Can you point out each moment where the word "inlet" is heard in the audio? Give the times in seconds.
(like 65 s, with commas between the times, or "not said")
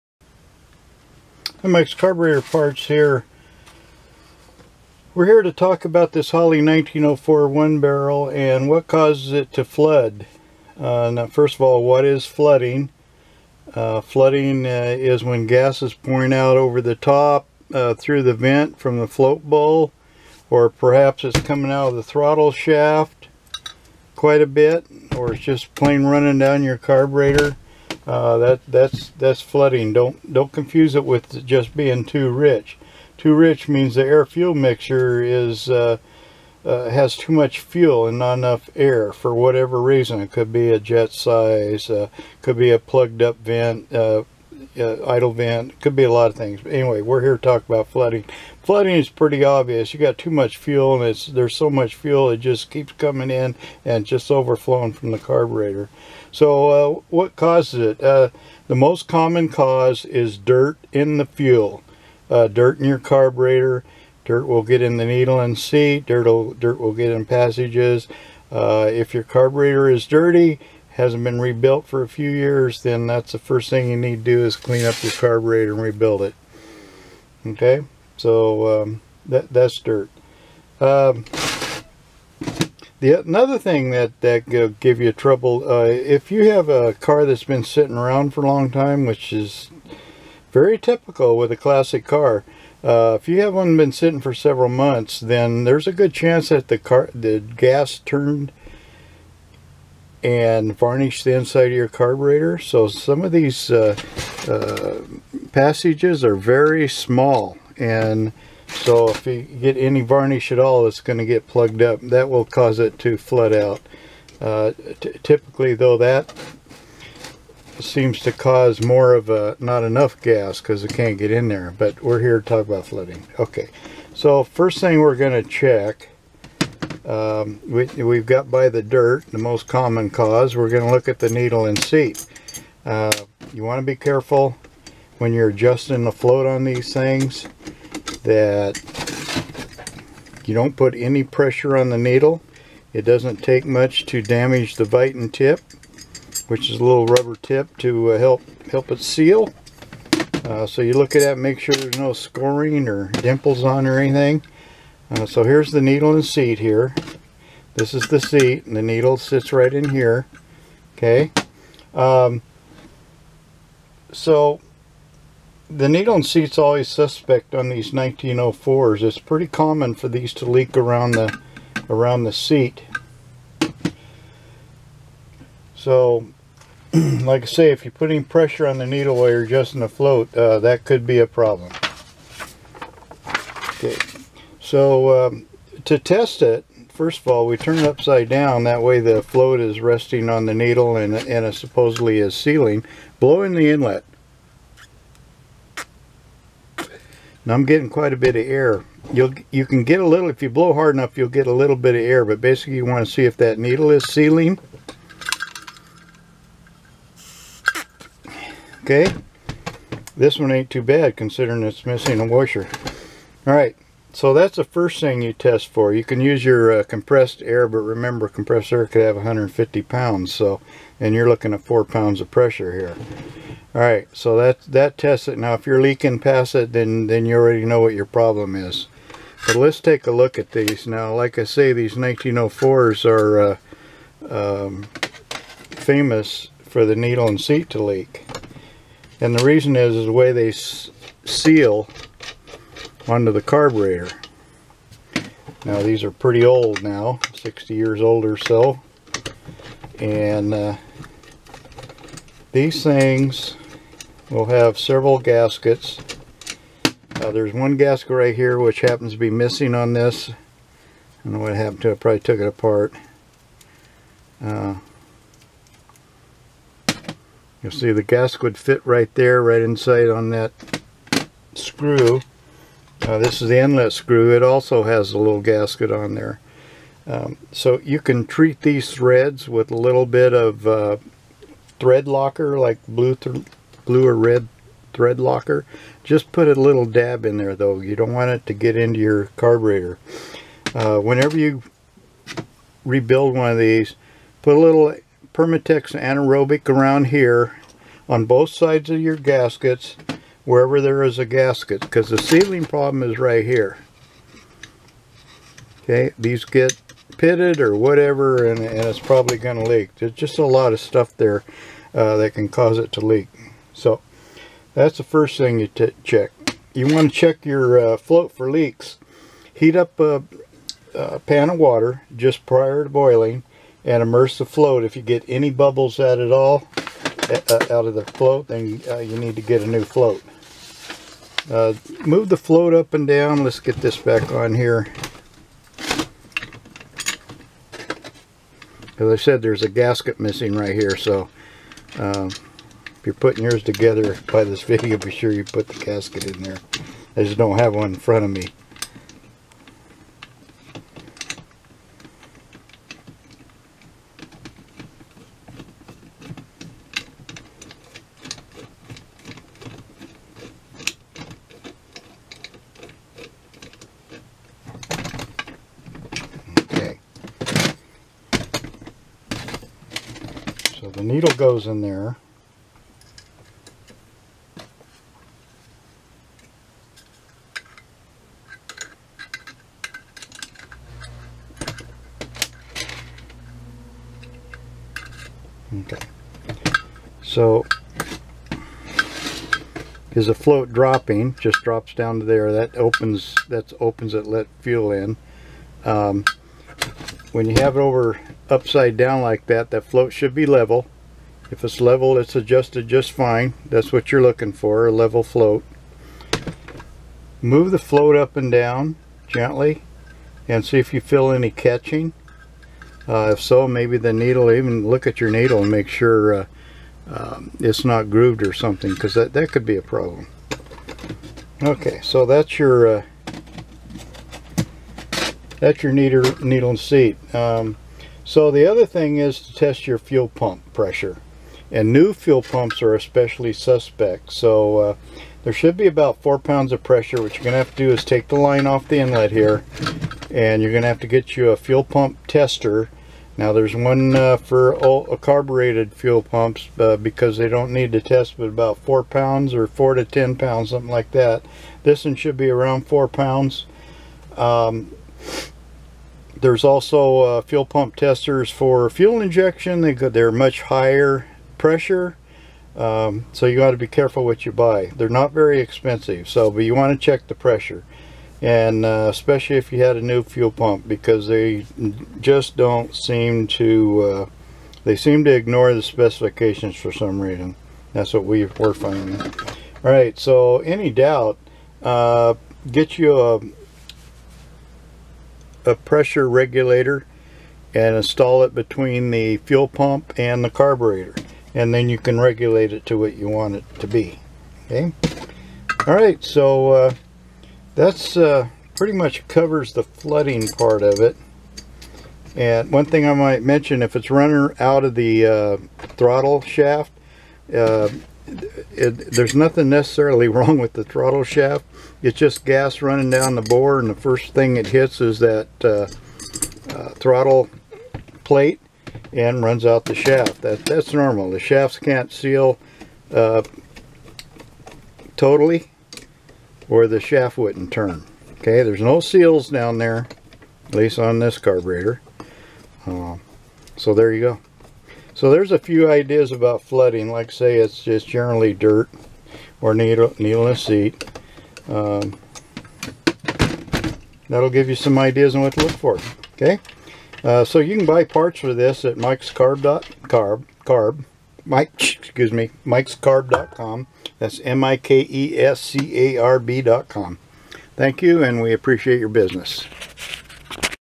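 193 s, 273 s, 438 s.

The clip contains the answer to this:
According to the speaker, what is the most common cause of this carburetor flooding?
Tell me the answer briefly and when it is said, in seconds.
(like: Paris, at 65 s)
Dirt in the fuel, at 60 s.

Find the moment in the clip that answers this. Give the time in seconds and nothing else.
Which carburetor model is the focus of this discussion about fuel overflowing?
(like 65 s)
6 s.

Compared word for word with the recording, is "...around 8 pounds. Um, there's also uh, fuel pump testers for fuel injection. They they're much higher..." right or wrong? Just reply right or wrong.
wrong.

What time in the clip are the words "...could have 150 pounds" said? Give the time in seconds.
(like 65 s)
218 s.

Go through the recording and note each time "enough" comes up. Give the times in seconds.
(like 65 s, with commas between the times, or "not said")
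38 s, 119 s, 200 s.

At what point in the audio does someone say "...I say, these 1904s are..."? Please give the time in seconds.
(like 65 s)
231 s.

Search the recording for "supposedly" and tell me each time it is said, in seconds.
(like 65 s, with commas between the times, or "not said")
191 s.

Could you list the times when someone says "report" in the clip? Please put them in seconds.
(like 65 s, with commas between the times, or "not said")
not said.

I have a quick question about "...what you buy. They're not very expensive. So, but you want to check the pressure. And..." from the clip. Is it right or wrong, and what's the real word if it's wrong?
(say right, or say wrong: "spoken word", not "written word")
right.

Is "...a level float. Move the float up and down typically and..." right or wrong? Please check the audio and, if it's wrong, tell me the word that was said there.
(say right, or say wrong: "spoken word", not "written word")
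wrong: "gently", not "typically".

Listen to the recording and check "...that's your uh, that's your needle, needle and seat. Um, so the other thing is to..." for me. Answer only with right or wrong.
right.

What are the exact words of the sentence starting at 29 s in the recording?
Don't don't confuse it with just being too rich.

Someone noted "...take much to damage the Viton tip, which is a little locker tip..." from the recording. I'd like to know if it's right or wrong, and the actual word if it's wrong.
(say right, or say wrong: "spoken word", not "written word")
wrong: "rubber", not "locker".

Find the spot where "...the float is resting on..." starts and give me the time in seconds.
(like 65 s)
188 s.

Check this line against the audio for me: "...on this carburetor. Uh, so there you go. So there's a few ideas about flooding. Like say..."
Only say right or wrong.
right.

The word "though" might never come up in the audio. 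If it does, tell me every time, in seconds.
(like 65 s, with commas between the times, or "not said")
115 s, 287 s.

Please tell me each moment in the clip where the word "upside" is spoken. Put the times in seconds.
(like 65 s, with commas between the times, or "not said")
187 s, 398 s.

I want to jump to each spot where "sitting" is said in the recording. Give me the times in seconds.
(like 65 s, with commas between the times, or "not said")
87 s, 93 s.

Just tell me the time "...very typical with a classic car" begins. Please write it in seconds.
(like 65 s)
90 s.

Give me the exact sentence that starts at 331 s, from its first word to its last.
Uh, move the float up and down.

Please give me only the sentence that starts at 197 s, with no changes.
Now I'm getting quite a bit of air.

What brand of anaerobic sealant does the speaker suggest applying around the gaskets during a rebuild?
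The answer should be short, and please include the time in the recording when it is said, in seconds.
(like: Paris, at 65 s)
Permatex, at 295 s.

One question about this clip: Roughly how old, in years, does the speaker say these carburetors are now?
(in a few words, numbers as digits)
60.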